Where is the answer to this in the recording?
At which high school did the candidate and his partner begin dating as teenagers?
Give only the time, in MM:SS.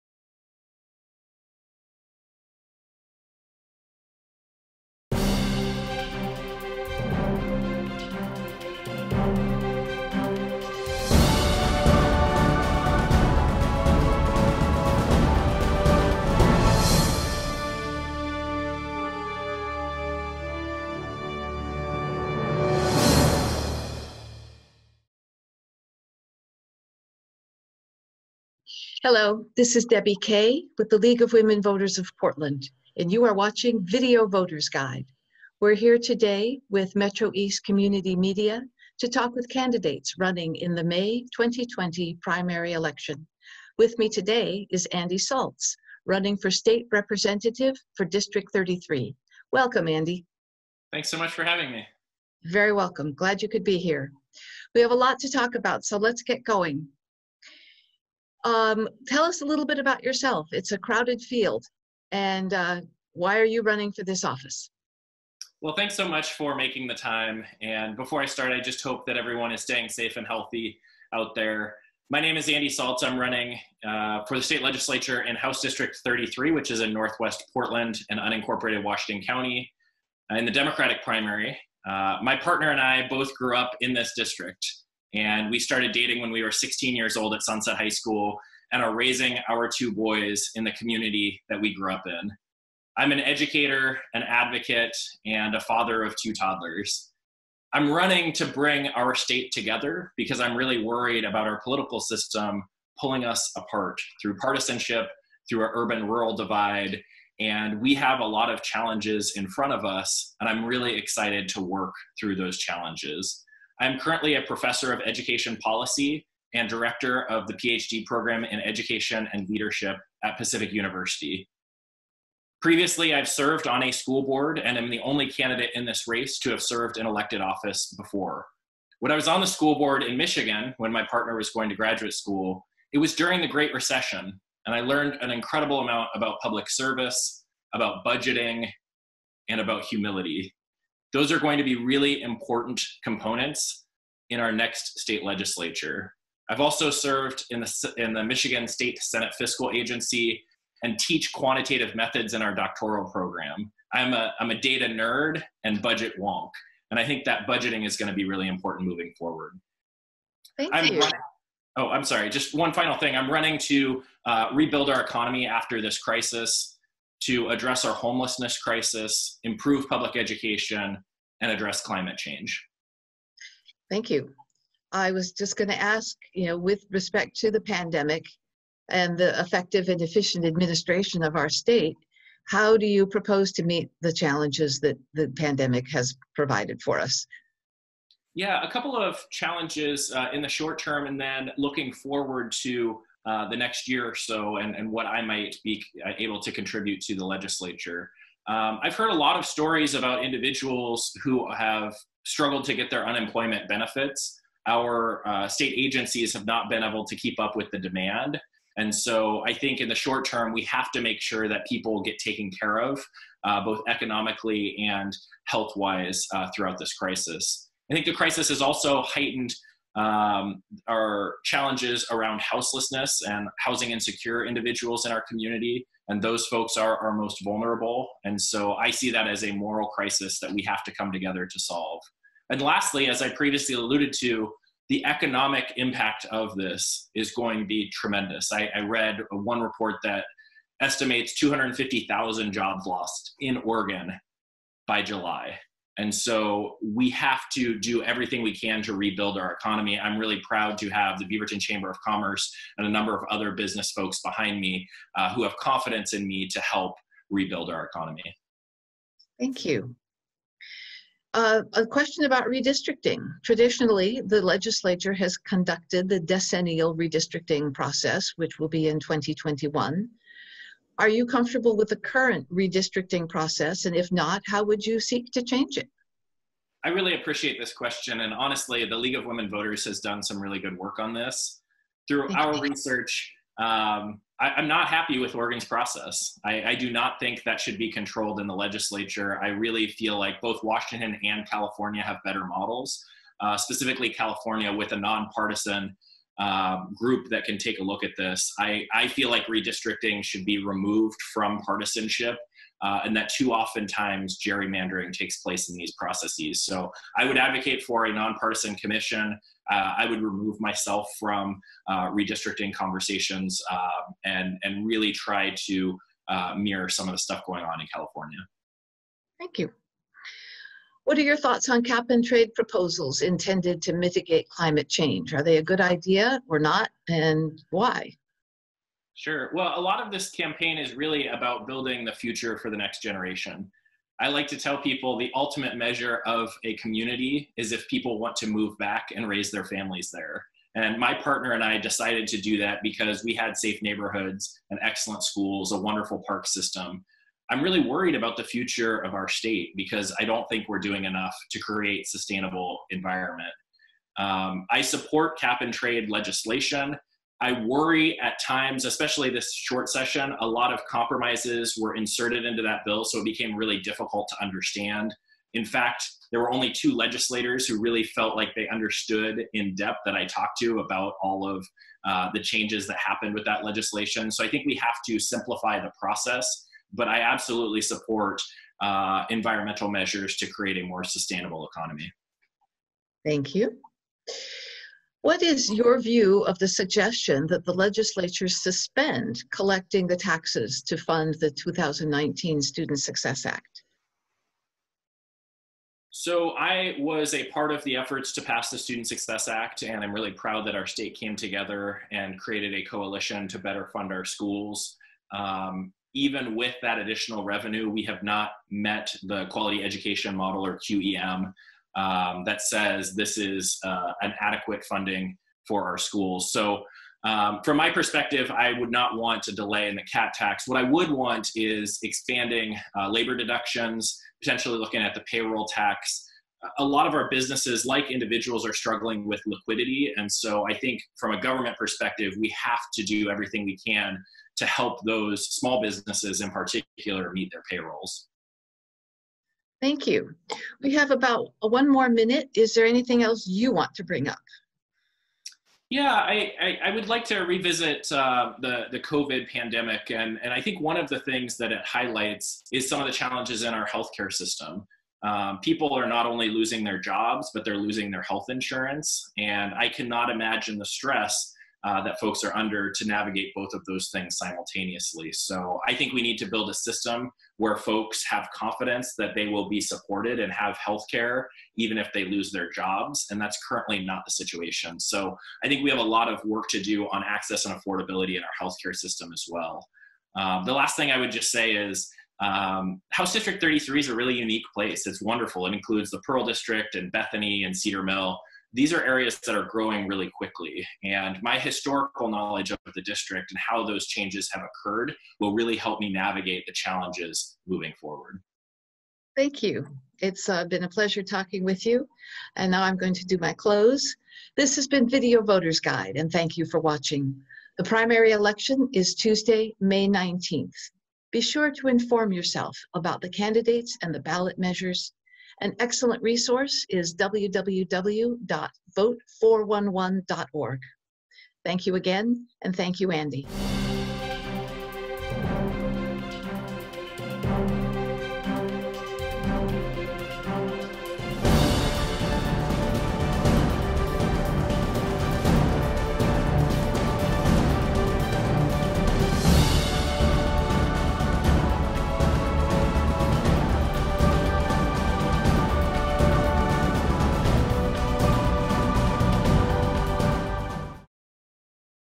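01:27.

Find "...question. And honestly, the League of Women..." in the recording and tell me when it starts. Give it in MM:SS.
04:37.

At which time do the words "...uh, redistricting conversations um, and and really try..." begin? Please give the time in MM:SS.
05:11.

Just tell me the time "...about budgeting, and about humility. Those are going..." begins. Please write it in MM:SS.
02:17.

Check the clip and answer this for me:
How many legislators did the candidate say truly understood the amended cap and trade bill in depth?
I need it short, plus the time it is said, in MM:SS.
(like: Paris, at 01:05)
2, at 06:06.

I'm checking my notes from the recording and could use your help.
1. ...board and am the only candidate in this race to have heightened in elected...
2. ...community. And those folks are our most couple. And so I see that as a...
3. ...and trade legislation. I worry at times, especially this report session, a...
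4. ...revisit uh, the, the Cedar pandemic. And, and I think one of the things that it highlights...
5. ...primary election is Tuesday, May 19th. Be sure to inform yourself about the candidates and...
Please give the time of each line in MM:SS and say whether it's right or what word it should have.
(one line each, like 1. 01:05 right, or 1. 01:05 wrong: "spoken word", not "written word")
1. 02:04 wrong: "served", not "heightened"
2. 03:45 wrong: "vulnerable", not "couple"
3. 05:55 wrong: "short", not "report"
4. 07:27 wrong: "COVID", not "Cedar"
5. 08:27 right.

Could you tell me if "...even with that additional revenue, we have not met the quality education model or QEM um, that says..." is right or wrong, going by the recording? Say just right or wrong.
right.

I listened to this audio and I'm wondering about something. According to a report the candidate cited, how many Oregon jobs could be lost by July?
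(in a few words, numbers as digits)
250,000.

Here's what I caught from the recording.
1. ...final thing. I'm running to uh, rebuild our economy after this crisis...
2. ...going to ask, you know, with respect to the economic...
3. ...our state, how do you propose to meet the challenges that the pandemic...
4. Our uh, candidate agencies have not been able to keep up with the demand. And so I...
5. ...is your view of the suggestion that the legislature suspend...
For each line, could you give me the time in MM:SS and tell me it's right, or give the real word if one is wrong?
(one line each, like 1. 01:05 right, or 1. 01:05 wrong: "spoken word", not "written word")
1. 02:42 right
2. 02:55 wrong: "pandemic", not "economic"
3. 03:01 right
4. 03:24 wrong: "state", not "candidate"
5. 06:25 right.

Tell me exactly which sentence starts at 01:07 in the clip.
And before I start, I just hope that everyone is staying safe and healthy out there.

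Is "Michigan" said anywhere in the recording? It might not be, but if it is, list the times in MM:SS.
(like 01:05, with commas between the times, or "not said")
02:10, 02:28.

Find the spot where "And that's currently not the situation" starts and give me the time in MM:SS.
07:53.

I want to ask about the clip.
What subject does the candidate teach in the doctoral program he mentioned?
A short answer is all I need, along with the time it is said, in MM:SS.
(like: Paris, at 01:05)
quantitative methods, at 02:31.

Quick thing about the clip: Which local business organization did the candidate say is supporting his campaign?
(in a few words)
Beaverton Chamber of Commerce.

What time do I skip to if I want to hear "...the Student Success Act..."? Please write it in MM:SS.
06:38.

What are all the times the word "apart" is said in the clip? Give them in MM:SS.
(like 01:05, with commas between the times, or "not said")
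01:43.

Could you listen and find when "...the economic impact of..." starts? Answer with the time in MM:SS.
03:54.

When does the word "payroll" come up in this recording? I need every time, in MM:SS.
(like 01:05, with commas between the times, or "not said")
07:05, 07:17.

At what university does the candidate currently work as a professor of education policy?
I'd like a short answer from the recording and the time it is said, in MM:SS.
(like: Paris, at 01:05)
Pacific University, at 02:00.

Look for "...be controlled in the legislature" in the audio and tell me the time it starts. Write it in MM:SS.
04:47.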